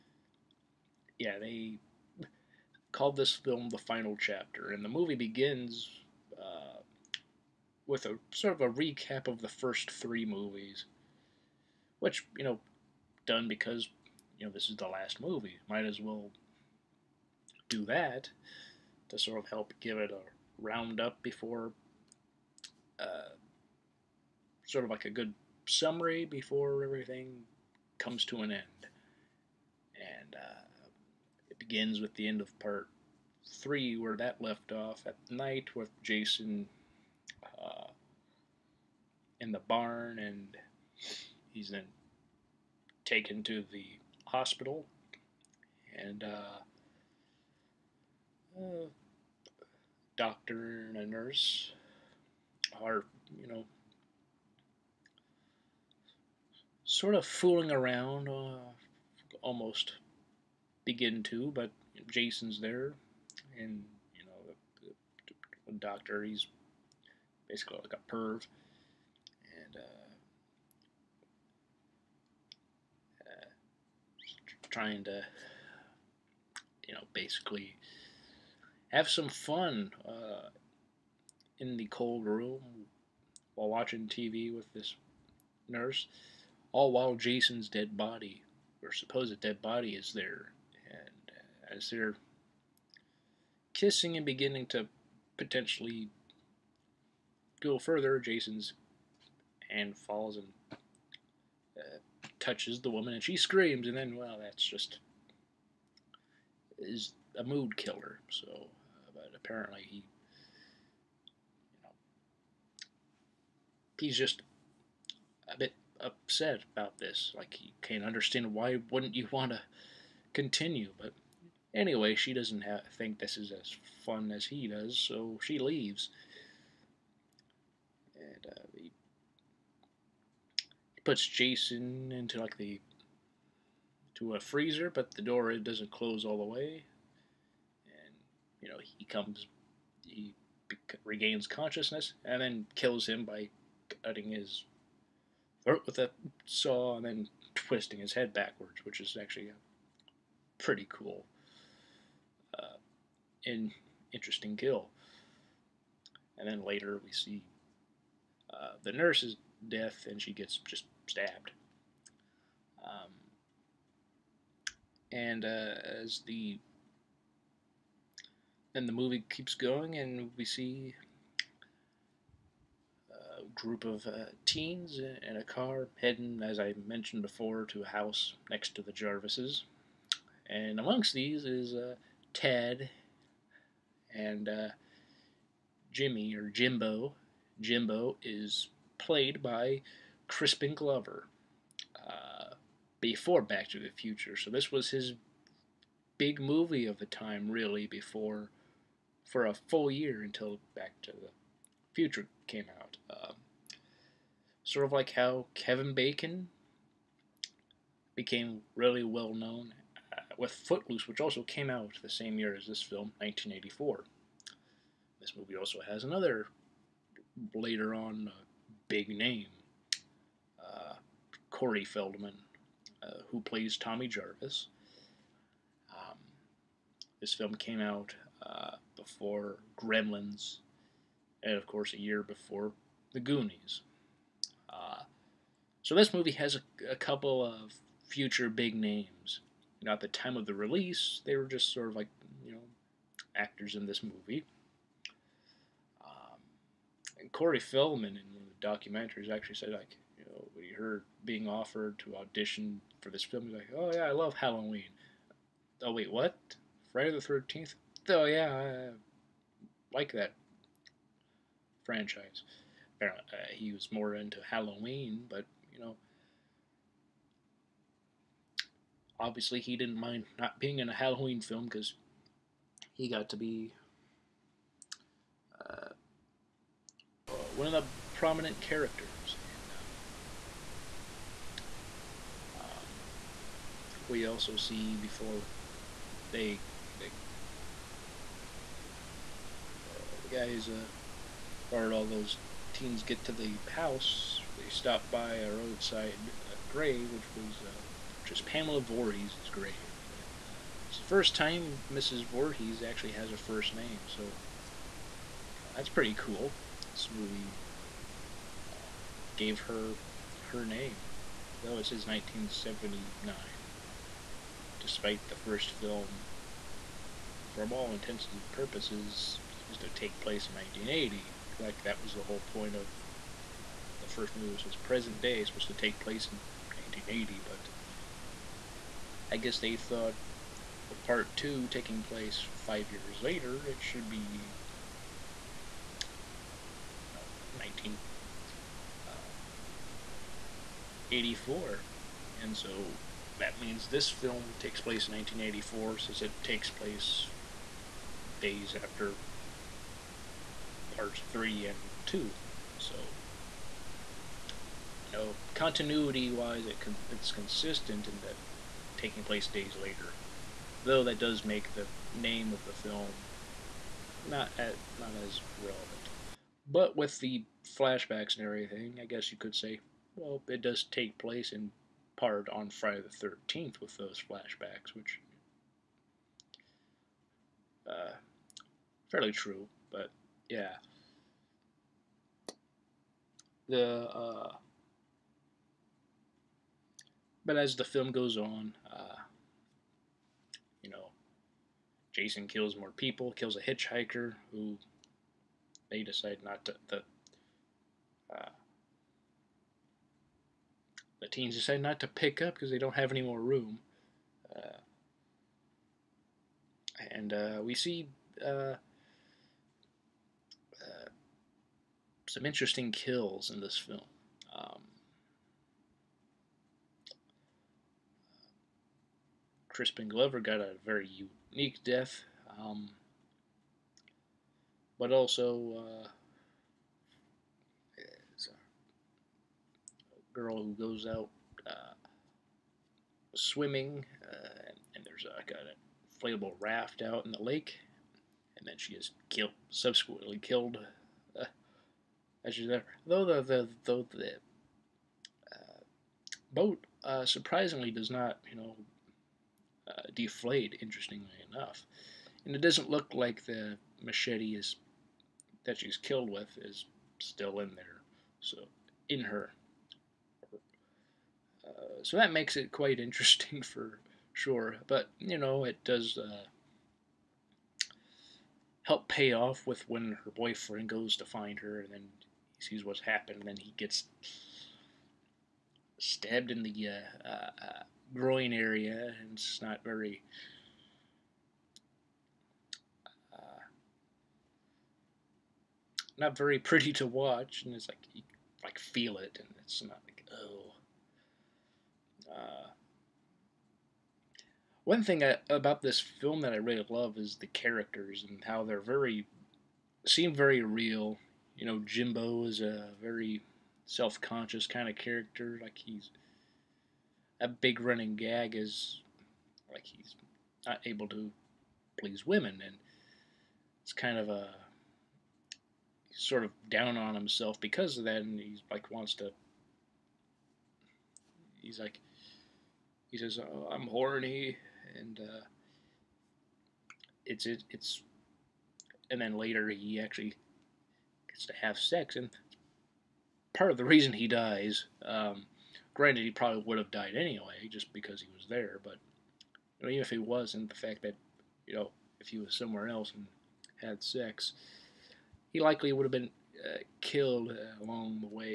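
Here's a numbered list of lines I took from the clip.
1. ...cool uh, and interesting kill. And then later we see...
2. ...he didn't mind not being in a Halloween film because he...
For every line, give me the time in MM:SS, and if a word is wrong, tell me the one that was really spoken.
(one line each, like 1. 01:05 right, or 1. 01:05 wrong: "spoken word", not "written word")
1. 02:30 right
2. 04:29 right.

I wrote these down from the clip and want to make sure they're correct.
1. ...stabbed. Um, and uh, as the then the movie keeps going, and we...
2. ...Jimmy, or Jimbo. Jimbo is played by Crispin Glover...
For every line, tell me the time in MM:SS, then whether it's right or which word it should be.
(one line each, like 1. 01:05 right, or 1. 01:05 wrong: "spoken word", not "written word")
1. 02:41 right
2. 03:05 right.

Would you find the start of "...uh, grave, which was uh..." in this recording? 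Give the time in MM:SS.
04:56.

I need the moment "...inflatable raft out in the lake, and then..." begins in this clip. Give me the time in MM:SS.
07:16.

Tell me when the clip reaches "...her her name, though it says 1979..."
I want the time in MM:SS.
05:09.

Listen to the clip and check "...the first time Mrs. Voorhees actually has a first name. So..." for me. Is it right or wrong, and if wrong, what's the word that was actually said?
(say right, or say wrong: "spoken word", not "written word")
right.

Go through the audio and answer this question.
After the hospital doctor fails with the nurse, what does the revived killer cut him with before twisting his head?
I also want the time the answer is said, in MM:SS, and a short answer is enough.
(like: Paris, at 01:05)
A saw, at 02:26.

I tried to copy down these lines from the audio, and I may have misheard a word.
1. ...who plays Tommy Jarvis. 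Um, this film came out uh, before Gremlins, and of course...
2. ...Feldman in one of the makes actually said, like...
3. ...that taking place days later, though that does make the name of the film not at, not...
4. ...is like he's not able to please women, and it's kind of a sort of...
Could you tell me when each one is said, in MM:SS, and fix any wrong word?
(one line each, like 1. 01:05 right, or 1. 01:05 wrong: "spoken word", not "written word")
1. 03:43 right
2. 04:07 wrong: "documentaries", not "makes"
3. 05:58 right
4. 08:28 right.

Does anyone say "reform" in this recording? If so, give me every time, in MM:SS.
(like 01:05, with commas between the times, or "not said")
not said.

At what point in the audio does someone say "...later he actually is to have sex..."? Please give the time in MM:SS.
08:49.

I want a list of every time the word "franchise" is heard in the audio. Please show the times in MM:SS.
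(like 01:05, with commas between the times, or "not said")
04:21.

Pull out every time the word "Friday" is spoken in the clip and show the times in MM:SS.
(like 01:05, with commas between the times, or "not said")
04:16, 06:12.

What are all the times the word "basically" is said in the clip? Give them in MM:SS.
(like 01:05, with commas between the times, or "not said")
01:07, 01:17.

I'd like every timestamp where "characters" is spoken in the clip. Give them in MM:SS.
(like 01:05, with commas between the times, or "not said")
04:38, 08:17, 08:24.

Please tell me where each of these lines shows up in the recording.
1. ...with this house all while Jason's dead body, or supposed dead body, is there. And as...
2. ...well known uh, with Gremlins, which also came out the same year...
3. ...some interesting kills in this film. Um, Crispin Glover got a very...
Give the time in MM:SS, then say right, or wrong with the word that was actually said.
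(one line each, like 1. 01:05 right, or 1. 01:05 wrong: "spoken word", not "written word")
1. 01:24 wrong: "nurse", not "house"
2. 03:29 wrong: "Footloose", not "Gremlins"
3. 06:52 right.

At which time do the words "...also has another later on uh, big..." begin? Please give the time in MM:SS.
03:35.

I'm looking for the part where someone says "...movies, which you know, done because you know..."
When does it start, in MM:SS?
00:10.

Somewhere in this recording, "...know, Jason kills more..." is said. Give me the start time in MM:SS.
06:30.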